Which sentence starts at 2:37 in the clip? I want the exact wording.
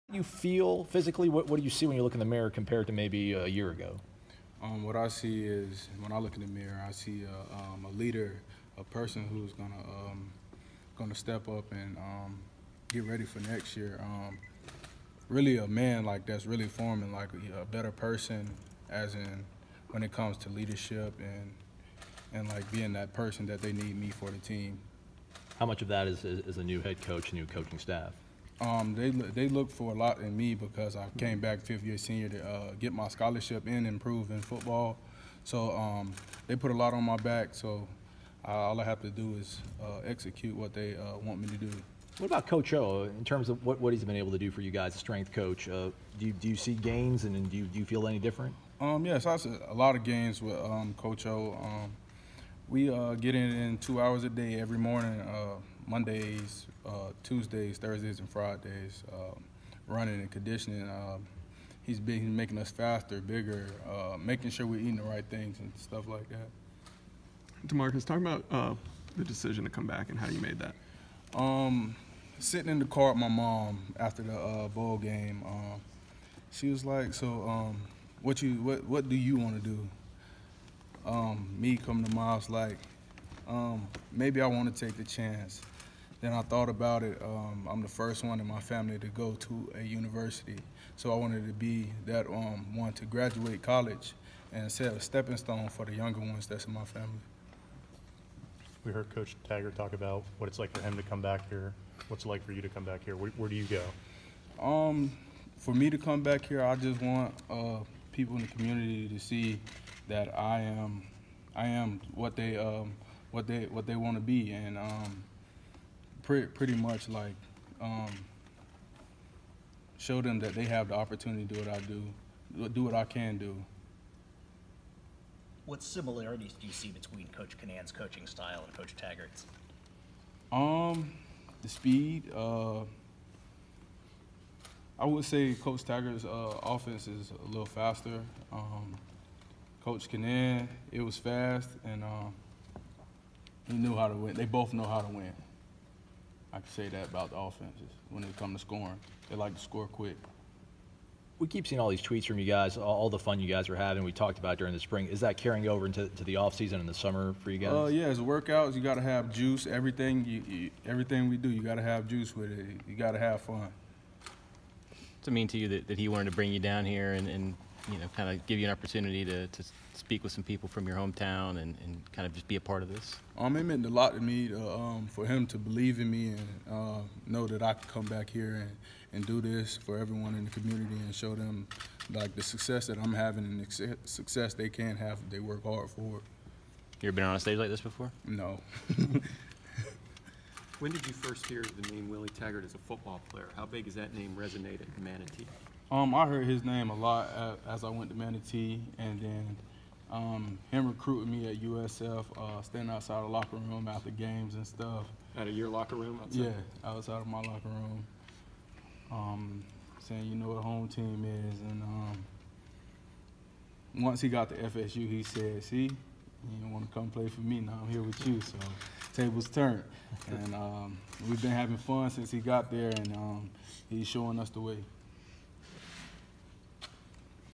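Oh uh, yeah, as workouts, you got to have juice.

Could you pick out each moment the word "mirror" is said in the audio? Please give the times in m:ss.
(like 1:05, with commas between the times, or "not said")
0:02, 0:06.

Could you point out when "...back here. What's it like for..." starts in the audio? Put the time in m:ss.
1:41.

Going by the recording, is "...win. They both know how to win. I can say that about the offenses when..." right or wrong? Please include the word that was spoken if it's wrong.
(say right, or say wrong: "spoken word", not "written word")
right.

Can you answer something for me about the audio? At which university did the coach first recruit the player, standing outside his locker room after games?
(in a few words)
USF.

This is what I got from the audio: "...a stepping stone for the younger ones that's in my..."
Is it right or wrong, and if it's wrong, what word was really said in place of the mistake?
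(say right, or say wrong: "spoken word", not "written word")
right.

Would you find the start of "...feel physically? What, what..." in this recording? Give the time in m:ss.
0:00.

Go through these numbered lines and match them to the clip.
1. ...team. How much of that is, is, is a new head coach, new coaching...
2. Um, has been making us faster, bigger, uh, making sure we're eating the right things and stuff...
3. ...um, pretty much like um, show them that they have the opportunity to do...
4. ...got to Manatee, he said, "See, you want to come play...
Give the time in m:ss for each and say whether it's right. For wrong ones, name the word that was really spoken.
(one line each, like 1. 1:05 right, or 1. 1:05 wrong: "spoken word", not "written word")
1. 0:24 right
2. 1:00 right
3. 1:54 right
4. 3:34 wrong: "FSU", not "Manatee".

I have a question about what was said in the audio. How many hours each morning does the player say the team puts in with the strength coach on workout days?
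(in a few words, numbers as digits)
2.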